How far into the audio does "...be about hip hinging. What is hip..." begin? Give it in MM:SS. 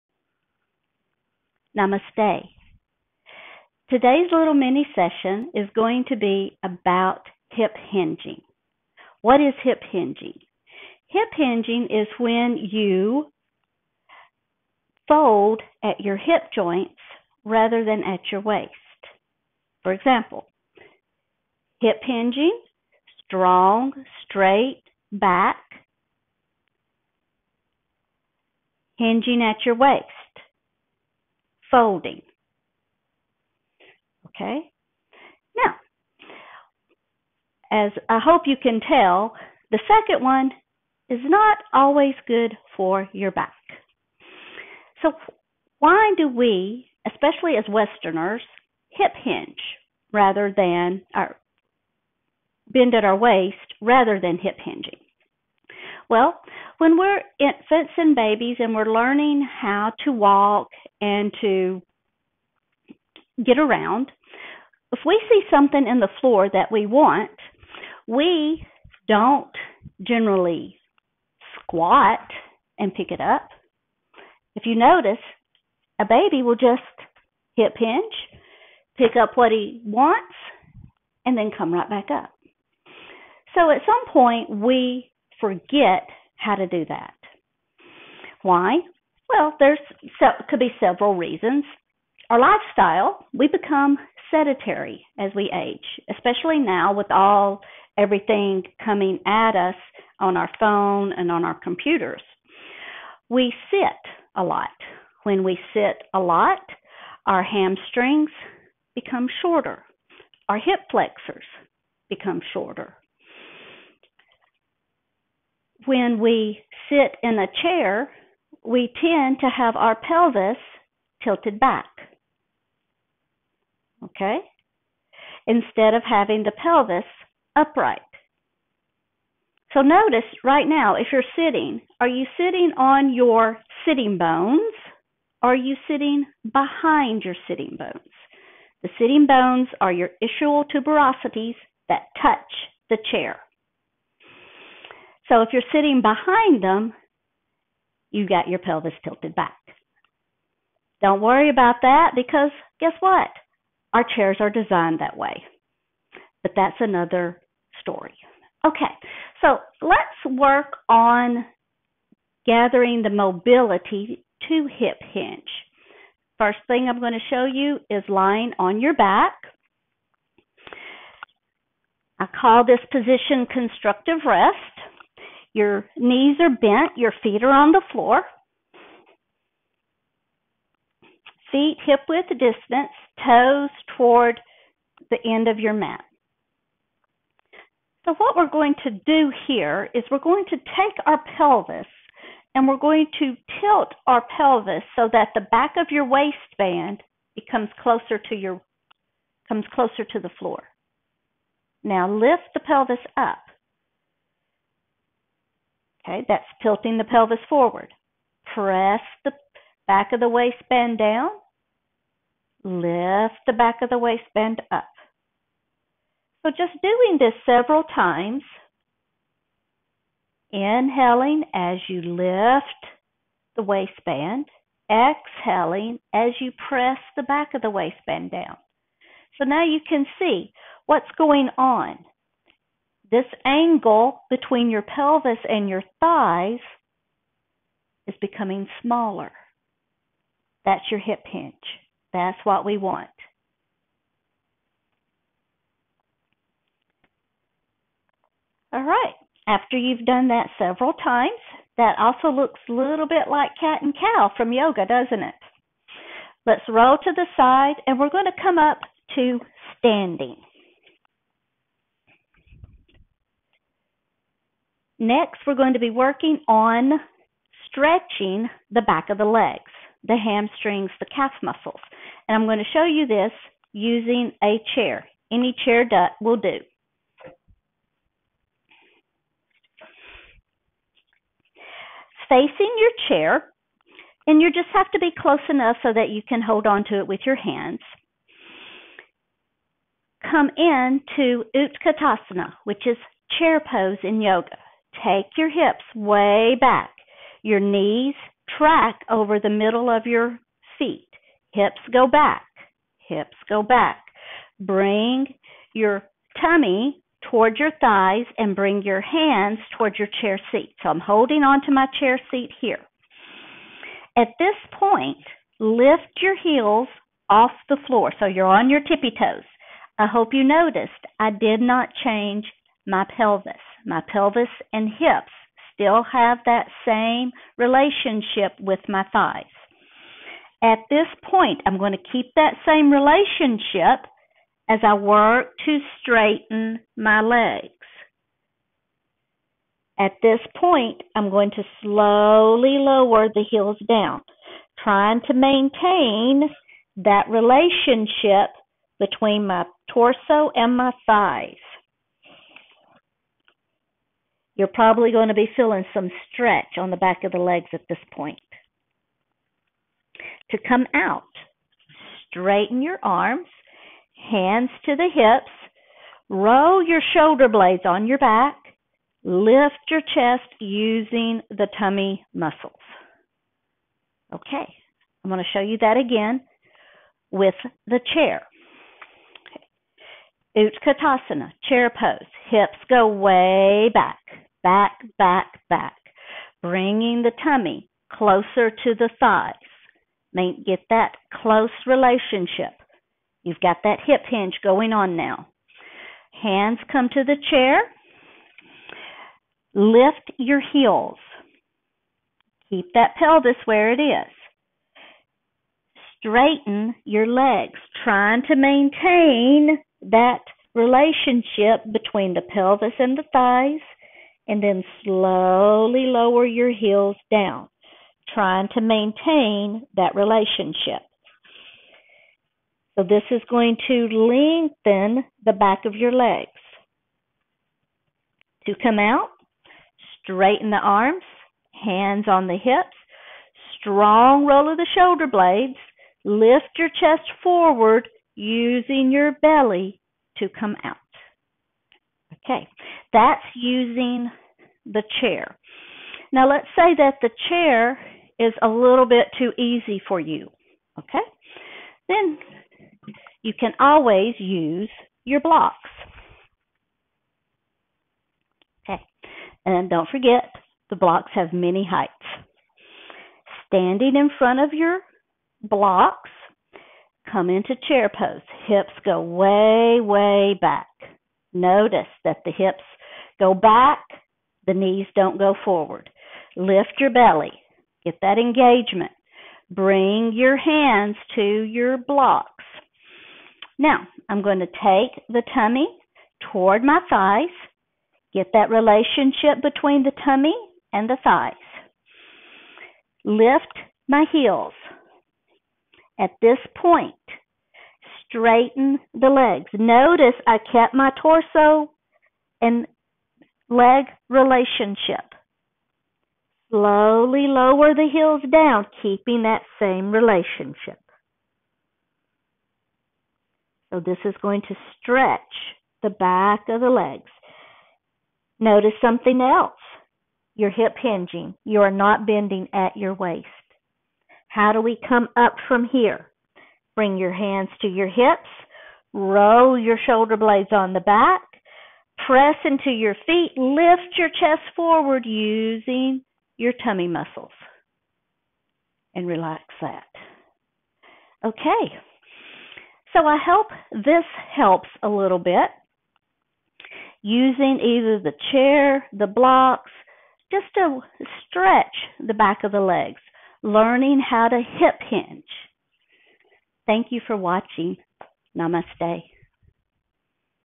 00:06.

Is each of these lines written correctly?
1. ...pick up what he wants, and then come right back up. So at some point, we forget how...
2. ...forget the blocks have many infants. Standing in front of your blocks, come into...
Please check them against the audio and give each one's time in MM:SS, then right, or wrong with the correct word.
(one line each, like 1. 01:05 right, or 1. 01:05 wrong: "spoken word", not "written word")
1. 01:18 right
2. 07:40 wrong: "heights", not "infants".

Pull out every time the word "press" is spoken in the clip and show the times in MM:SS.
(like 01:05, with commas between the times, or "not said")
03:28, 03:46, 08:52.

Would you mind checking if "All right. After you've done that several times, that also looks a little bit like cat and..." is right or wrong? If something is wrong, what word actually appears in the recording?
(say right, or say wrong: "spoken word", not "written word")
right.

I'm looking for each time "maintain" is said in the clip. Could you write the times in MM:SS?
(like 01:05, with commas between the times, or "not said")
05:45, 06:48, 06:58.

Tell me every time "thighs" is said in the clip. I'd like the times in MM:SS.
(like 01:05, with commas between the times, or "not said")
03:55, 05:07, 05:29, 05:51, 06:29, 06:53, 08:07, 08:11.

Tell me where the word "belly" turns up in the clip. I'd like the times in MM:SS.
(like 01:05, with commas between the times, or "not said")
07:19, 07:57.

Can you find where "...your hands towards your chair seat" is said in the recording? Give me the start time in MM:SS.
05:08.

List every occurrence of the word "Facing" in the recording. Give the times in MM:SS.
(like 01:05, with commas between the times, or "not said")
04:42.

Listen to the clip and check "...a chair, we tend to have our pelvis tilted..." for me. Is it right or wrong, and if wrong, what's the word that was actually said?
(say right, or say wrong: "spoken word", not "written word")
right.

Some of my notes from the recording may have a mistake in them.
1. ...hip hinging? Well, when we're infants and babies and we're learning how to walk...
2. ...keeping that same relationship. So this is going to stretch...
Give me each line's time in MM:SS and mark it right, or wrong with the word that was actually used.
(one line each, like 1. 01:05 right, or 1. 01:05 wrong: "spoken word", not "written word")
1. 00:54 right
2. 08:29 right.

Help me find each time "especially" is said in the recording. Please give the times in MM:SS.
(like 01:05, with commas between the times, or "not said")
00:47, 01:36.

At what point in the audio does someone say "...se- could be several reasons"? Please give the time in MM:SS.
01:30.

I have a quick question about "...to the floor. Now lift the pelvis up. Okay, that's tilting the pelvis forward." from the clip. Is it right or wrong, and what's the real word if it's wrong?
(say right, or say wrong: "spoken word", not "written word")
right.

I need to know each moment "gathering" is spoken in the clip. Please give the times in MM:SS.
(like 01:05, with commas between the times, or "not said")
02:42.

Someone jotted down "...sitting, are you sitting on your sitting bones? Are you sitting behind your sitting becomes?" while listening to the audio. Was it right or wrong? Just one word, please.
wrong.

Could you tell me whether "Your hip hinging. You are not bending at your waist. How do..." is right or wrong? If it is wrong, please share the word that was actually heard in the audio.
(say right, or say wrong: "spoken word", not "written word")
right.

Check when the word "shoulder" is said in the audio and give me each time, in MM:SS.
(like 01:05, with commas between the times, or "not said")
06:07, 07:14, 08:50.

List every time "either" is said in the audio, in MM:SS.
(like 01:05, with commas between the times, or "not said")
09:07.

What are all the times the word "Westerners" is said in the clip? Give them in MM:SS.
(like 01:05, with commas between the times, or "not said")
00:47.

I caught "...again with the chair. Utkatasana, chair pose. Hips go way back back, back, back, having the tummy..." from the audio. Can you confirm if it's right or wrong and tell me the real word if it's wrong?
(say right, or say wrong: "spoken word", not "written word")
wrong: "bringing", not "having".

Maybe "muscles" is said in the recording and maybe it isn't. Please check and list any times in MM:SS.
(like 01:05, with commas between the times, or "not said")
04:31, 06:12, 08:57.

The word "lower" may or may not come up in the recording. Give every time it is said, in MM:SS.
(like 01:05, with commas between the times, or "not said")
05:42, 06:56, 08:27.